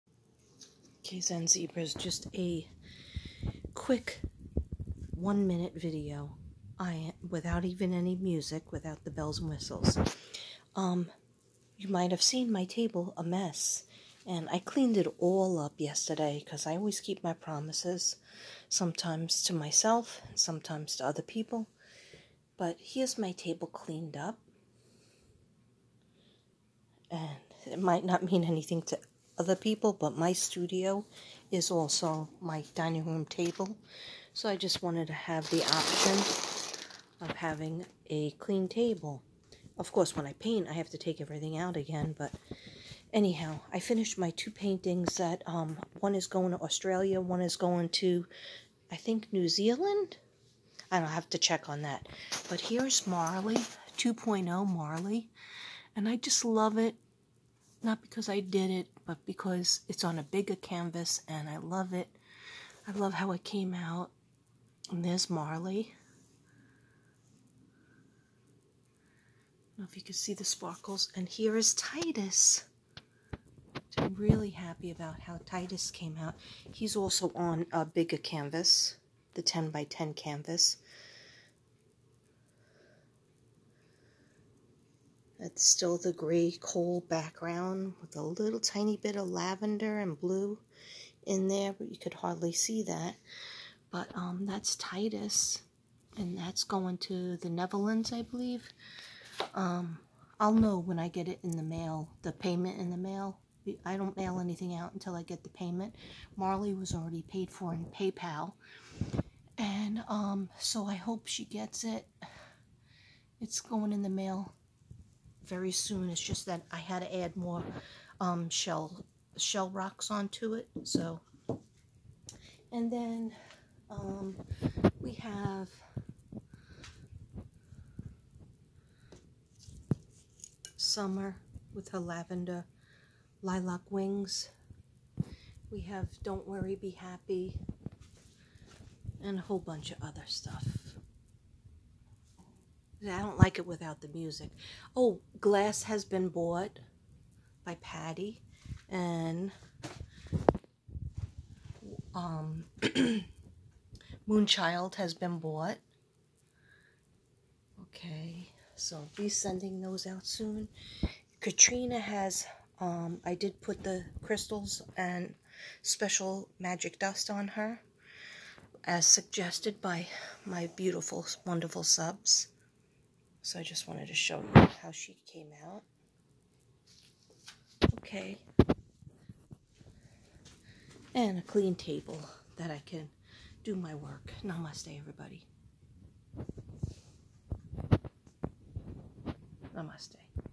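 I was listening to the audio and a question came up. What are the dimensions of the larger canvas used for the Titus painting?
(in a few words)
10 by 10.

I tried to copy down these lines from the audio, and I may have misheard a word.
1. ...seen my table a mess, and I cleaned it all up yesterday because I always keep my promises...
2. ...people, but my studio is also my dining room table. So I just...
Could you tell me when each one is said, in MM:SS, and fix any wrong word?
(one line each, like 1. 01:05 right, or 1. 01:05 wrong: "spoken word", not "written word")
1. 00:12 right
2. 00:29 right.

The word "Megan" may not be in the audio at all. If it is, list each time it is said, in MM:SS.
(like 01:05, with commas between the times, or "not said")
not said.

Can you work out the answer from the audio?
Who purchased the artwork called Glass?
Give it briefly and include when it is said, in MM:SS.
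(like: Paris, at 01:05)
Patty, at 02:27.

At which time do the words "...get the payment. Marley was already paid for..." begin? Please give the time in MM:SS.
01:45.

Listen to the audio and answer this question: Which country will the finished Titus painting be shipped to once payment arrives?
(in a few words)
The Netherlands.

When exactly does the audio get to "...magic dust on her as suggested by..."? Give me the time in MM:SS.
02:46.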